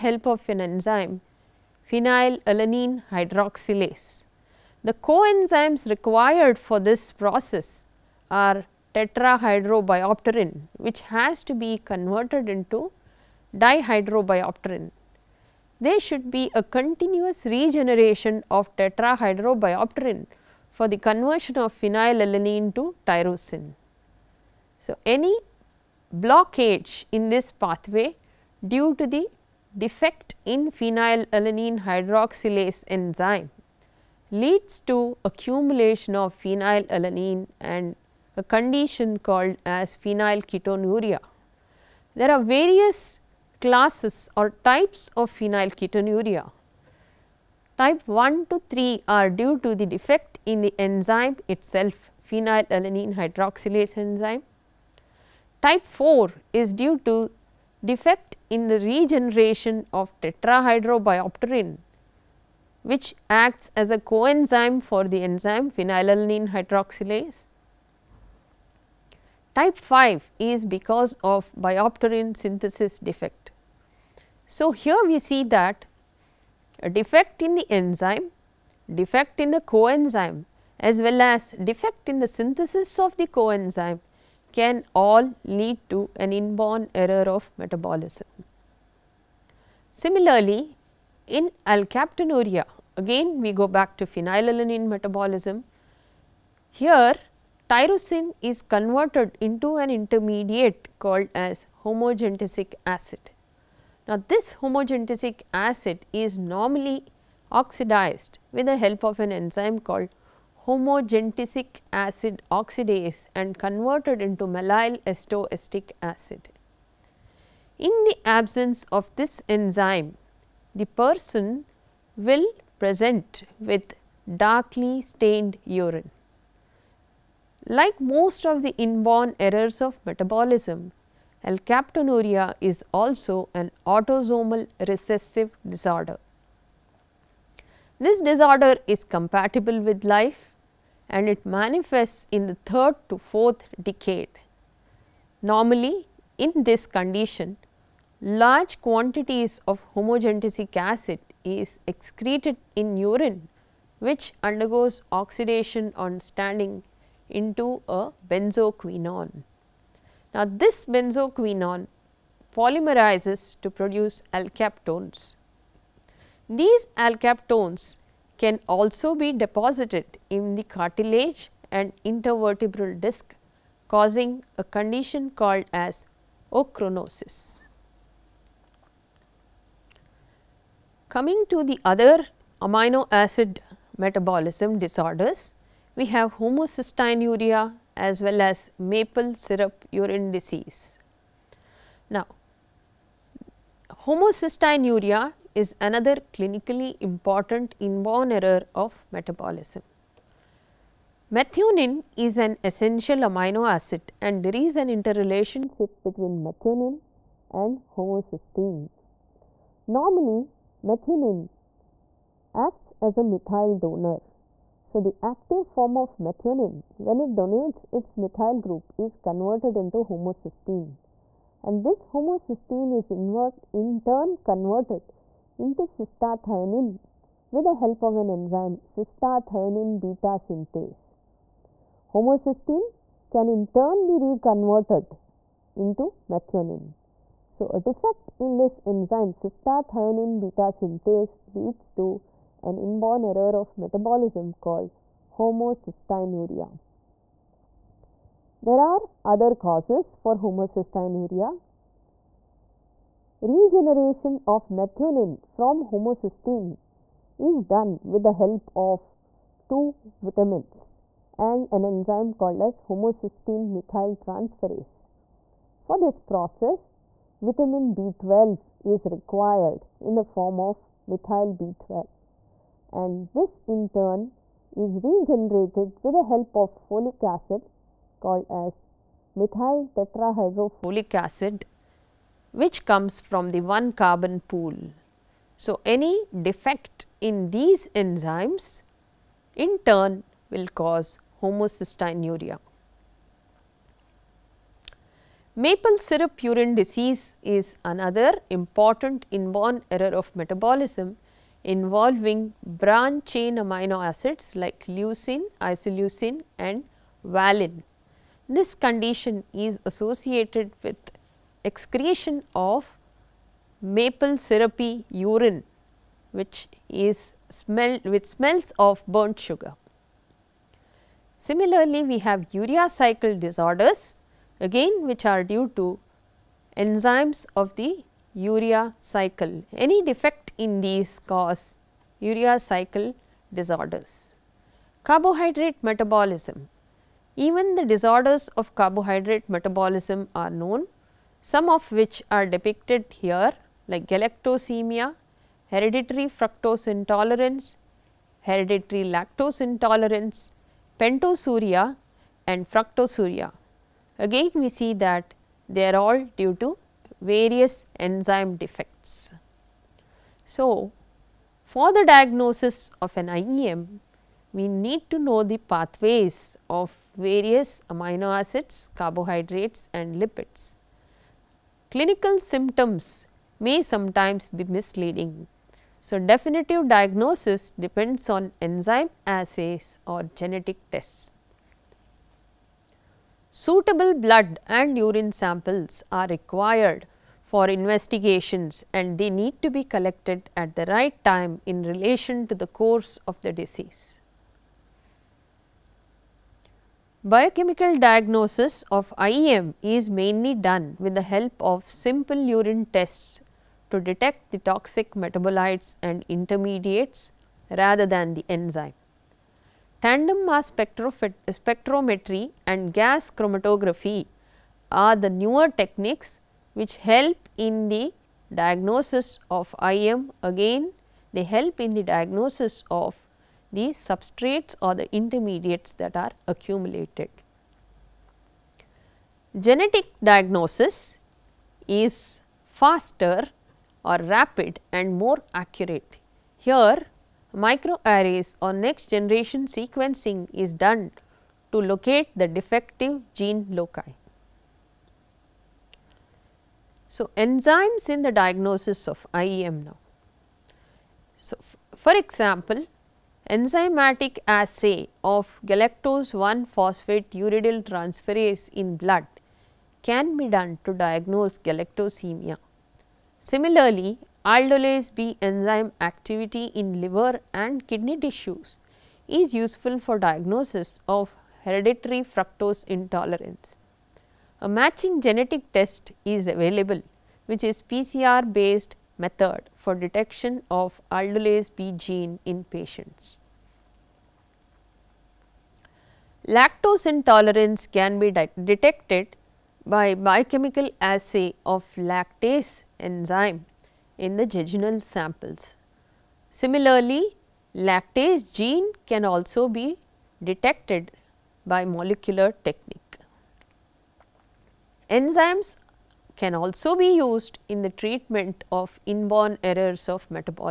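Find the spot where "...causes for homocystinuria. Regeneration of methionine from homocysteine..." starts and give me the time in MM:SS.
04:09.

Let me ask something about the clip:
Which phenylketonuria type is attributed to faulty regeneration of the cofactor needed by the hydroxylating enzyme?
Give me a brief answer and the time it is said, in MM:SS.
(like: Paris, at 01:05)
Type 4, at 00:55.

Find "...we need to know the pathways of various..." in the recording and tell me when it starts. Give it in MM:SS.
06:04.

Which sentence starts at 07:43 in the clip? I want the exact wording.
Similarly, Aldolase B enzyme activity in liver and kidney tissues is useful for diagnosis of hereditary fructose intolerance.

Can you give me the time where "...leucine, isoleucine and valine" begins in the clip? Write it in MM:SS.
05:04.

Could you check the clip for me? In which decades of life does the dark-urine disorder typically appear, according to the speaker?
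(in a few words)
third to fourth decade.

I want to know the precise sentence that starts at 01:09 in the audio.
Type 5 is because of biopterin synthesis defect.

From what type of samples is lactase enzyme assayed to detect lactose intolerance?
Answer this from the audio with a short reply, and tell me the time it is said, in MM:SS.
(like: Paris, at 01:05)
jejunal samples, at 08:14.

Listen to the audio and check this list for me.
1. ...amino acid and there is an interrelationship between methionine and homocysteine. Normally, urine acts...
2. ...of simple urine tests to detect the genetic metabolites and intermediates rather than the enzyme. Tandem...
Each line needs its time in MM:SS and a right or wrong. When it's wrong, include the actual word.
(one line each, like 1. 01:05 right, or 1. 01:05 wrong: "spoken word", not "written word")
1. 03:23 wrong: "methionine", not "urine"
2. 06:41 wrong: "toxic", not "genetic".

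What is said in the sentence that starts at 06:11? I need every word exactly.
Clinical symptoms may sometimes be misleading.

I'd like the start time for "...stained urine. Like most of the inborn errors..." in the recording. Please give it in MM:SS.
02:05.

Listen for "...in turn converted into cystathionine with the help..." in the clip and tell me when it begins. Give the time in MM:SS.
03:43.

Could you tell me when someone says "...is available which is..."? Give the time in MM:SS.
07:56.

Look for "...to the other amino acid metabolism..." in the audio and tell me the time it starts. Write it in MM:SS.
03:01.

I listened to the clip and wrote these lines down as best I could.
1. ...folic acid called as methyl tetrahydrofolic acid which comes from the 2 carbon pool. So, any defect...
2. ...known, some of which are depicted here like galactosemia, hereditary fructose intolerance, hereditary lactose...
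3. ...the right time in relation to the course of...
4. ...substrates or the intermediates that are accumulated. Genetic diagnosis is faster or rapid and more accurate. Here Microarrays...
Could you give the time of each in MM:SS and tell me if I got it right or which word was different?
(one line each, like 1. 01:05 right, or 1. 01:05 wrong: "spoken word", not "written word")
1. 04:36 wrong: "1", not "2"
2. 05:40 right
3. 06:30 right
4. 07:04 right.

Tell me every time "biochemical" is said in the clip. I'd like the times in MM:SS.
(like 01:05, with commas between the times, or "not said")
06:37, 08:10.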